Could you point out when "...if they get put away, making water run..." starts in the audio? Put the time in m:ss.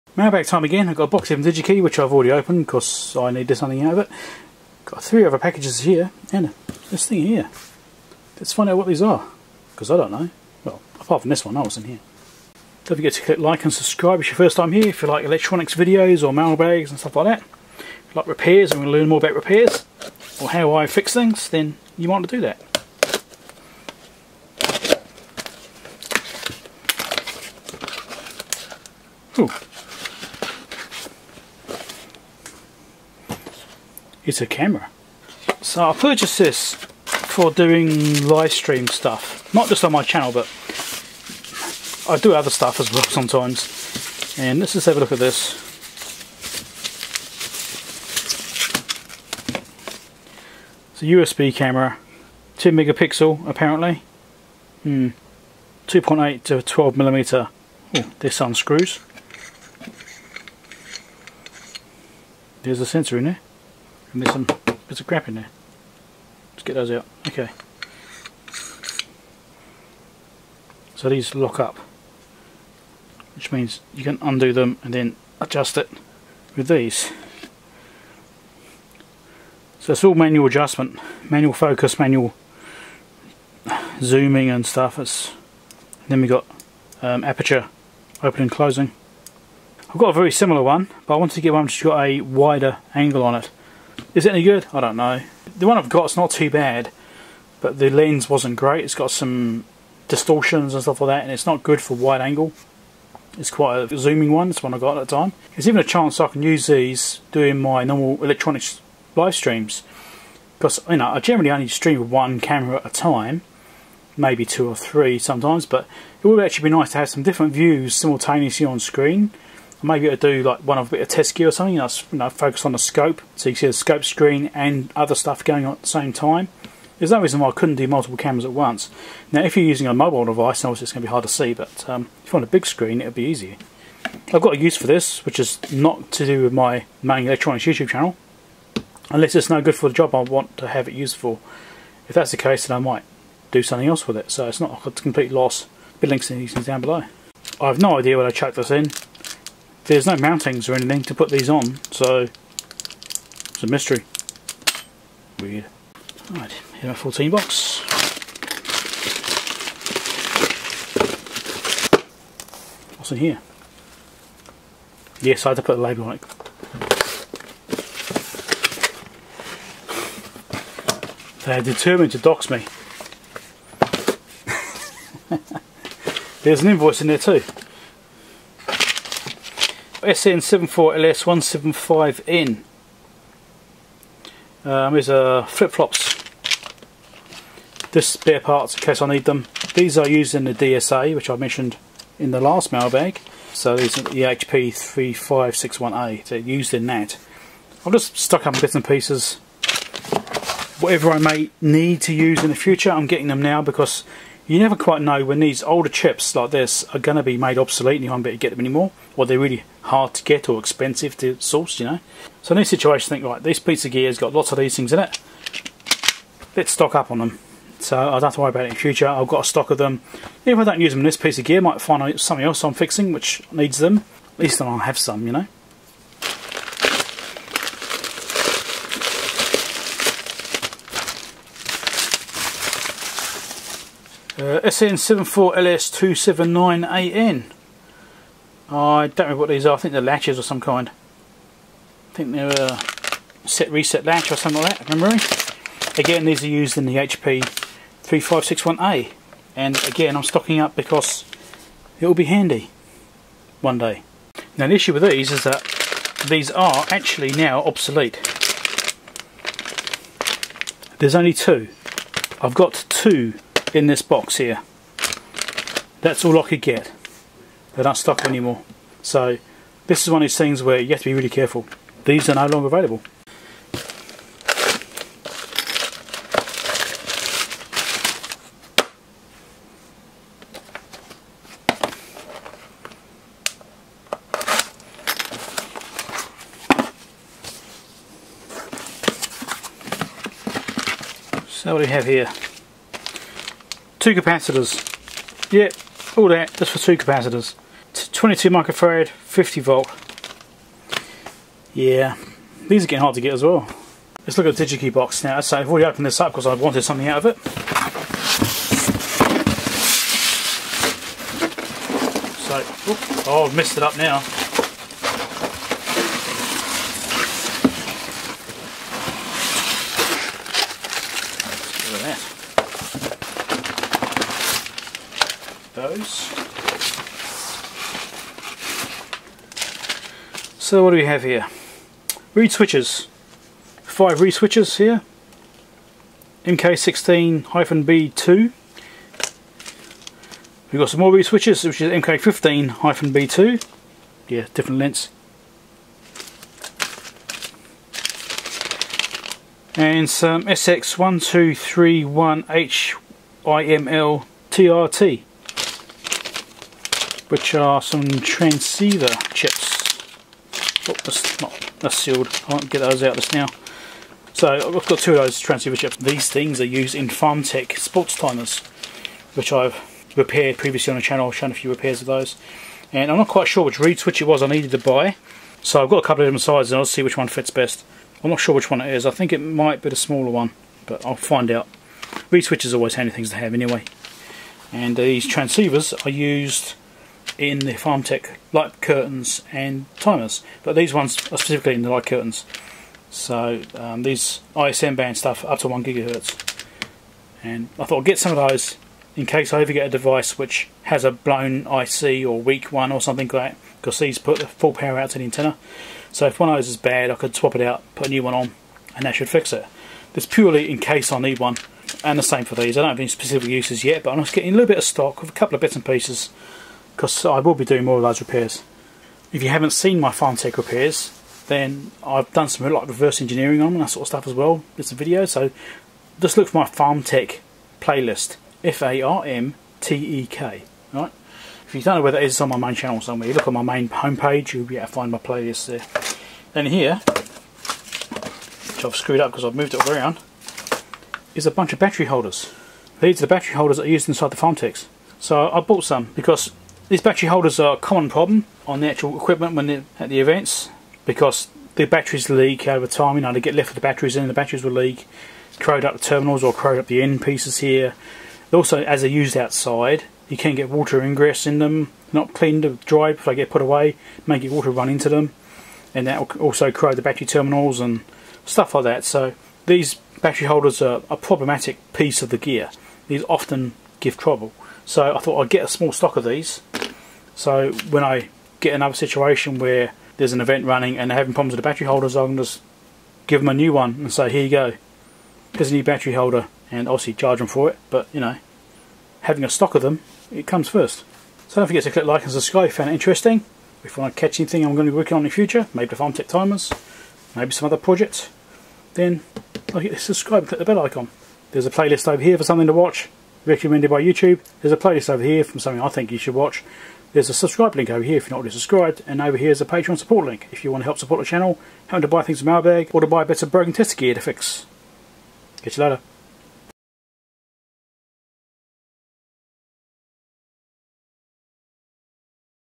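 7:43.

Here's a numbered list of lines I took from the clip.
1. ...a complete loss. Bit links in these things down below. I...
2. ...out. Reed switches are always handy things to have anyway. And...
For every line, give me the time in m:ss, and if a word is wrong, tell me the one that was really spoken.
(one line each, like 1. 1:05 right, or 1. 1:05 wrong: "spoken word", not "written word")
1. 2:24 right
2. 6:21 right.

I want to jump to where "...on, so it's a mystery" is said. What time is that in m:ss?
2:31.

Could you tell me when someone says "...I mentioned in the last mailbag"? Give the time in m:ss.
3:11.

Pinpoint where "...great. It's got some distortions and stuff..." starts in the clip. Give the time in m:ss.
1:38.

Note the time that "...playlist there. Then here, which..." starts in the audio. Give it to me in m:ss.
7:15.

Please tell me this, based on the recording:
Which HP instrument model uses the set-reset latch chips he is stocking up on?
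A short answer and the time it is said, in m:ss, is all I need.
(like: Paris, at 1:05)
HP 3561A, at 4:06.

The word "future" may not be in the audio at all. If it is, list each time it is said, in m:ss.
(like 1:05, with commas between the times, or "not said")
3:22, 3:38, 8:15.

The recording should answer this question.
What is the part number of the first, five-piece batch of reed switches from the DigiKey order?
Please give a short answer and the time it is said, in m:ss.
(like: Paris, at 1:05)
MK16-B2, at 5:36.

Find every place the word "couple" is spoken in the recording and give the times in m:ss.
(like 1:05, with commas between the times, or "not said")
6:16, 6:55.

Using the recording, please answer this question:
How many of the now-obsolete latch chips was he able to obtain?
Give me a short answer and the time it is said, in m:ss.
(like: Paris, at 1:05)
2, at 4:21.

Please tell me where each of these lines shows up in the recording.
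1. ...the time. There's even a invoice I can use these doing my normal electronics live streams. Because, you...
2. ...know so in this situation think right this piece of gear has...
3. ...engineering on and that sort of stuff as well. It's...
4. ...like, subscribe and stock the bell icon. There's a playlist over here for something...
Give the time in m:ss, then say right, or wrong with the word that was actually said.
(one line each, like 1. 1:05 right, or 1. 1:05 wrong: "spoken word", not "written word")
1. 1:45 wrong: "chance", not "invoice"
2. 3:31 right
3. 7:03 right
4. 8:19 wrong: "click", not "stock".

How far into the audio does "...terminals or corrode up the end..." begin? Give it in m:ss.
7:36.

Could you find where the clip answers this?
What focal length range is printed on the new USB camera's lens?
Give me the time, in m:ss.
0:55.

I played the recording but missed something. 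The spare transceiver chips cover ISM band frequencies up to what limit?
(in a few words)
1 gigahertz.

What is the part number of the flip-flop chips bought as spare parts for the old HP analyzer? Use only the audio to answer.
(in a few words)
SN74LS175N.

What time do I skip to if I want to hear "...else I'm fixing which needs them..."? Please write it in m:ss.
3:42.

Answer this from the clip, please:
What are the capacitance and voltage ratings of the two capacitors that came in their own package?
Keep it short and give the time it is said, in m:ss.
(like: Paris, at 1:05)
22 microfarad, 50 volt, at 4:58.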